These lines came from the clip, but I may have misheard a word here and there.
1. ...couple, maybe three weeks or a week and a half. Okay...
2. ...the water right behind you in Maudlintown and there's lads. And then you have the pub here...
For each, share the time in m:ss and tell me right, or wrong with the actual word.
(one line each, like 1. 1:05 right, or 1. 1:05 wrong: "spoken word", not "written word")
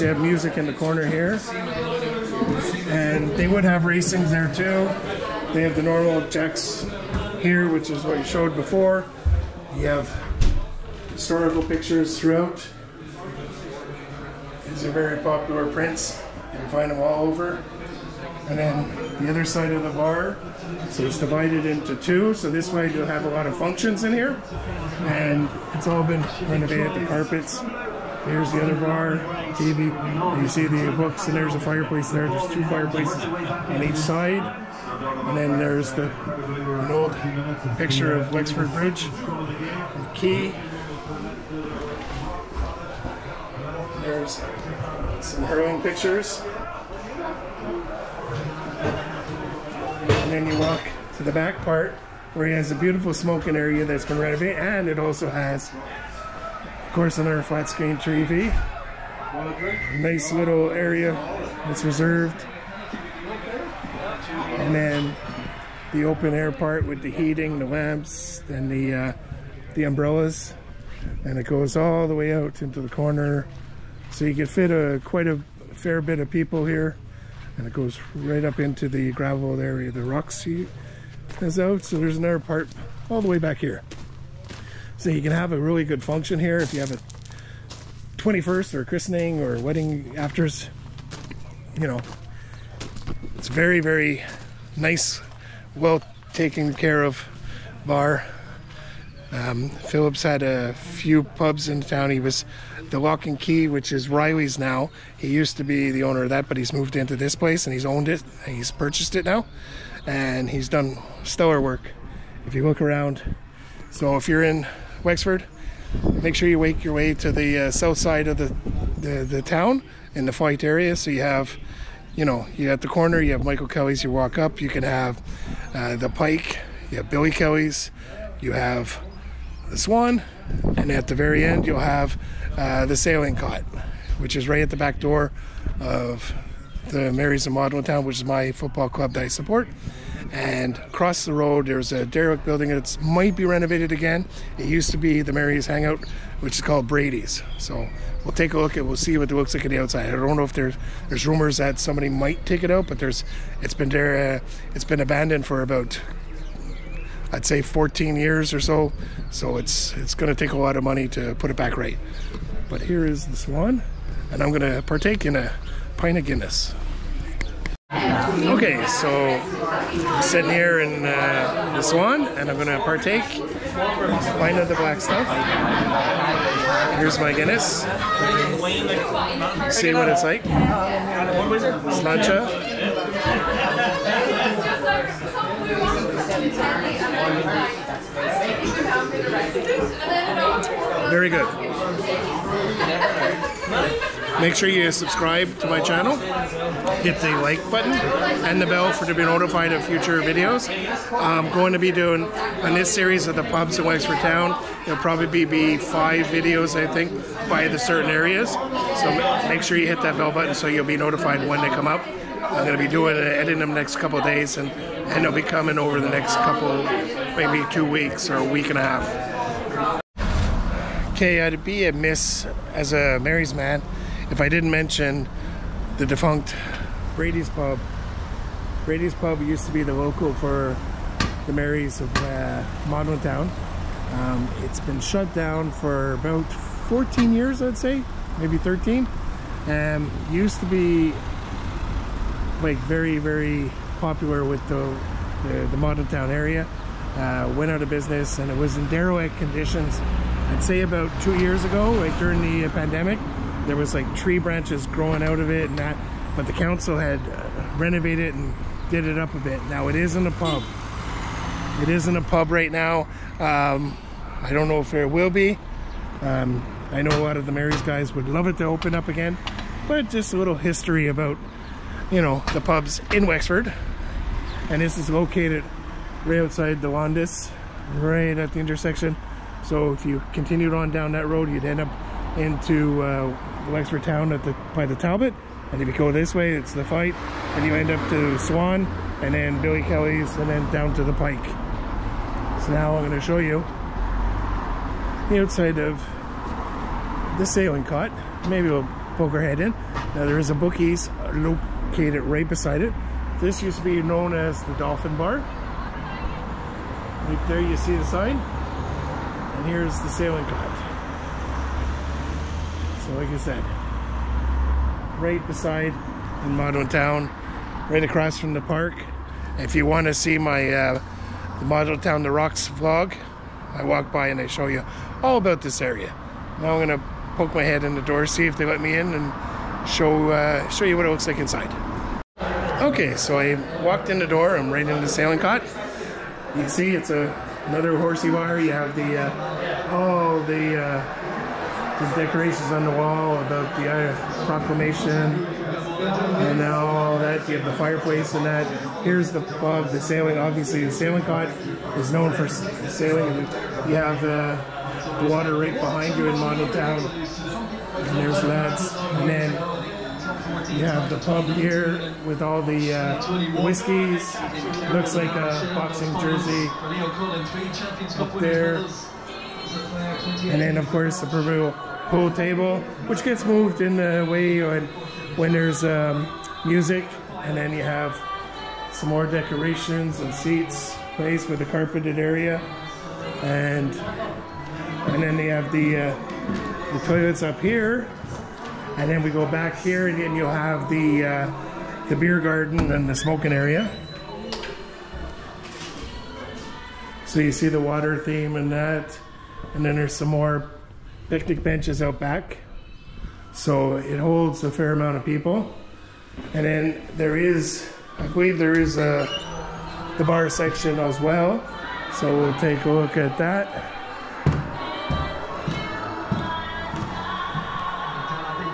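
1. 3:36 wrong: "two", not "three"
2. 5:55 right.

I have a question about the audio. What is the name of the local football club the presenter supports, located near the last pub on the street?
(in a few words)
Marys of Maudlintown.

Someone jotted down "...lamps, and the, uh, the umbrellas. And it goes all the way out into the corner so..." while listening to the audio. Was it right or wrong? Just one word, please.
right.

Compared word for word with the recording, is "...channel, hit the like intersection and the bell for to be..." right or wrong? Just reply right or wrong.
wrong.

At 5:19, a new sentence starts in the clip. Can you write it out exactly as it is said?
If you want to see my uh, Maudlintown The Rocks vlog, I walk by and I show you all about this area.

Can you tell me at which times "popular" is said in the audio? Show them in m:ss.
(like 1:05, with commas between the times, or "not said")
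0:15, 4:04.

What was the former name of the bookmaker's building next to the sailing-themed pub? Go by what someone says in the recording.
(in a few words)
The Dolphin Bar.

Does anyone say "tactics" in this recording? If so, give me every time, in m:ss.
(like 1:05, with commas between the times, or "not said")
not said.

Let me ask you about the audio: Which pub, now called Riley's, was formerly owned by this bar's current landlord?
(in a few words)
The Lock and Key.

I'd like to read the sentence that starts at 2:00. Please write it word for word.
So you have, you know, you at the corner, you have Michael Kelly's.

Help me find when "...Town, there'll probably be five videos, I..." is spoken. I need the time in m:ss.
3:24.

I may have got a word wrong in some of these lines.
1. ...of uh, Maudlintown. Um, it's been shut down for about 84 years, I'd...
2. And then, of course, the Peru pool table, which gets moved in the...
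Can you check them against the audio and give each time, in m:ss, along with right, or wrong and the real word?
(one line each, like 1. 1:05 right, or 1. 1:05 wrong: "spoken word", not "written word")
1. 3:52 wrong: "14", not "84"
2. 6:10 right.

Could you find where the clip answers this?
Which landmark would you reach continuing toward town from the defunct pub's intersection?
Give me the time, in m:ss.
4:44.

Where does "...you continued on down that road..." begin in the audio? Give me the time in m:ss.
4:40.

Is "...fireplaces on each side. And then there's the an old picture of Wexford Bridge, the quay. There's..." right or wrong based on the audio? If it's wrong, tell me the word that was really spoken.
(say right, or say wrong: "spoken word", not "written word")
right.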